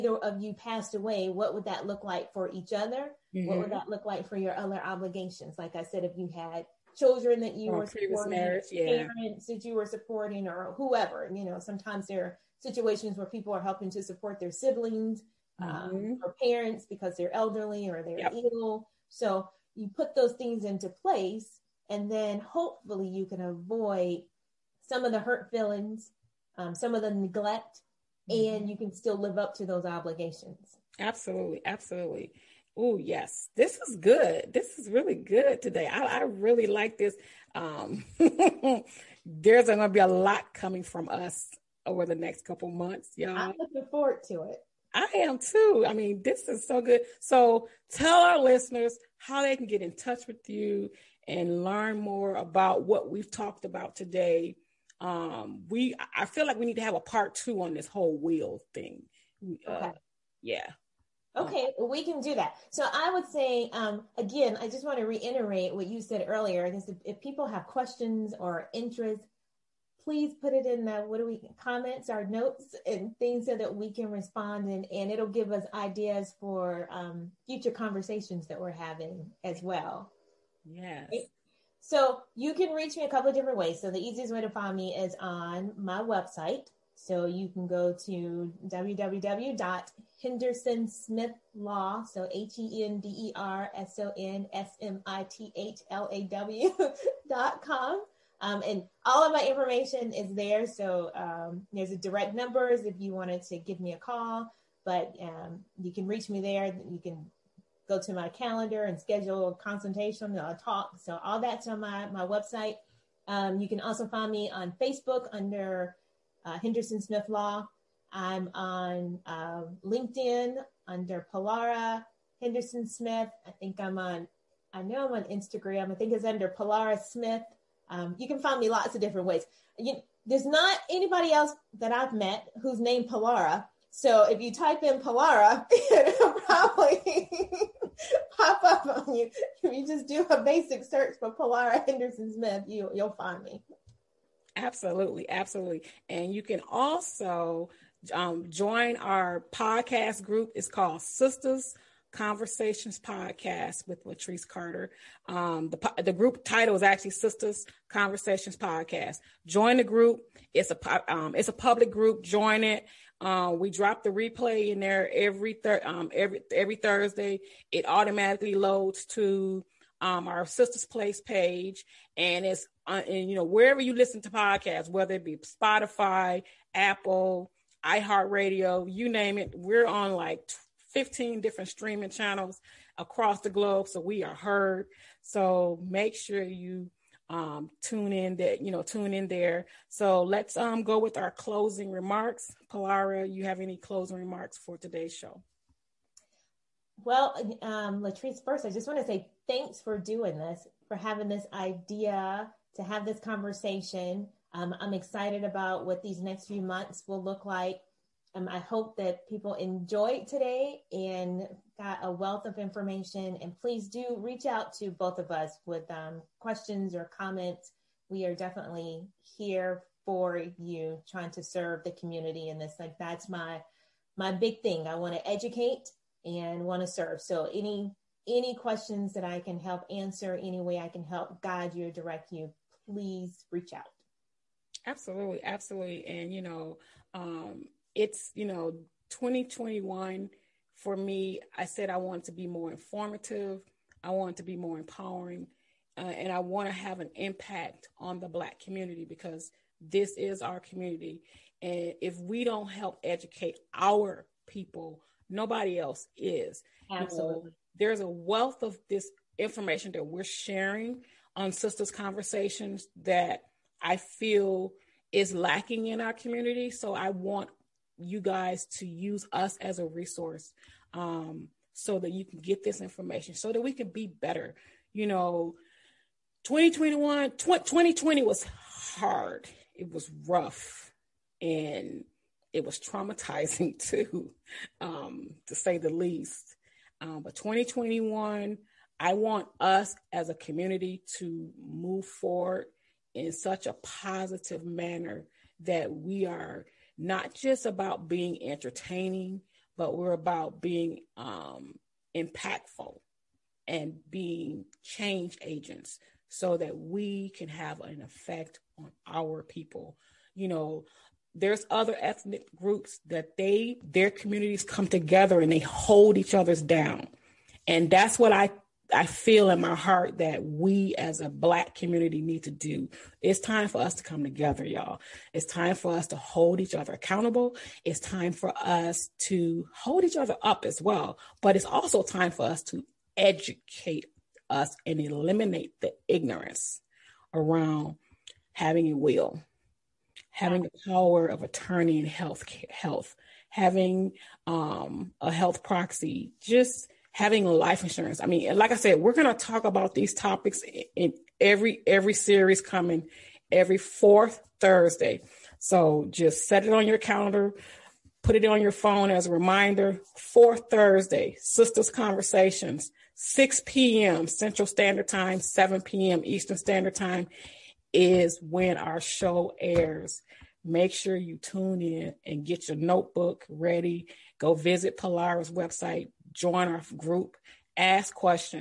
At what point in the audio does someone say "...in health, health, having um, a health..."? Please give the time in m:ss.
5:41.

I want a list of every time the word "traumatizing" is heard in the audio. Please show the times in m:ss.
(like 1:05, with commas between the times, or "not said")
4:42.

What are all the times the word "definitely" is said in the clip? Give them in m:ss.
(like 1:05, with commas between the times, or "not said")
3:38.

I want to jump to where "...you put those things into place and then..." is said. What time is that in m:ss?
0:19.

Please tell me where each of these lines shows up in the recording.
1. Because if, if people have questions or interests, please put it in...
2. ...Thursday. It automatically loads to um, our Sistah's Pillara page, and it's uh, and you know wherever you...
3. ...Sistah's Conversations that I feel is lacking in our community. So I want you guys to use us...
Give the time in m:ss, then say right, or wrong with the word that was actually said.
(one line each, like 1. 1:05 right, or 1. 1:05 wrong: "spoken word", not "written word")
1. 1:06 right
2. 2:46 wrong: "Place", not "Pillara"
3. 4:21 right.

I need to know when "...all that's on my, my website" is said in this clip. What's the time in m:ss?
1:51.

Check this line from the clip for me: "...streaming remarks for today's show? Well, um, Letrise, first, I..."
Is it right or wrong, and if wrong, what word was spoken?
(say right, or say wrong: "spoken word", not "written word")
wrong: "closing", not "streaming".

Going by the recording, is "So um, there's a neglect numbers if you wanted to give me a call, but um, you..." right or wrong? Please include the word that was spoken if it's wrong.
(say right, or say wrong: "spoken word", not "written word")
wrong: "direct", not "neglect".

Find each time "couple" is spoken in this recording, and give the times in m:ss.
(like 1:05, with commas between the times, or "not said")
0:42, 1:23.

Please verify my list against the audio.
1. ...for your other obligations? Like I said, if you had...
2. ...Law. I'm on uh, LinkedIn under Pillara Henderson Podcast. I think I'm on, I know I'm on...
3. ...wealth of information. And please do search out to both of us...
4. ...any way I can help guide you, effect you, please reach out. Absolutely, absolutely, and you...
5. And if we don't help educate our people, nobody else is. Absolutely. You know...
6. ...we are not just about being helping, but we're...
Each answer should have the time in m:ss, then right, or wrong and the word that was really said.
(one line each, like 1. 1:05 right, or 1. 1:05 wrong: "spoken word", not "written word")
1. 0:04 right
2. 1:57 wrong: "Smith", not "Podcast"
3. 3:32 wrong: "reach", not "search"
4. 3:50 wrong: "direct", not "effect"
5. 4:11 right
6. 4:55 wrong: "entertaining", not "helping".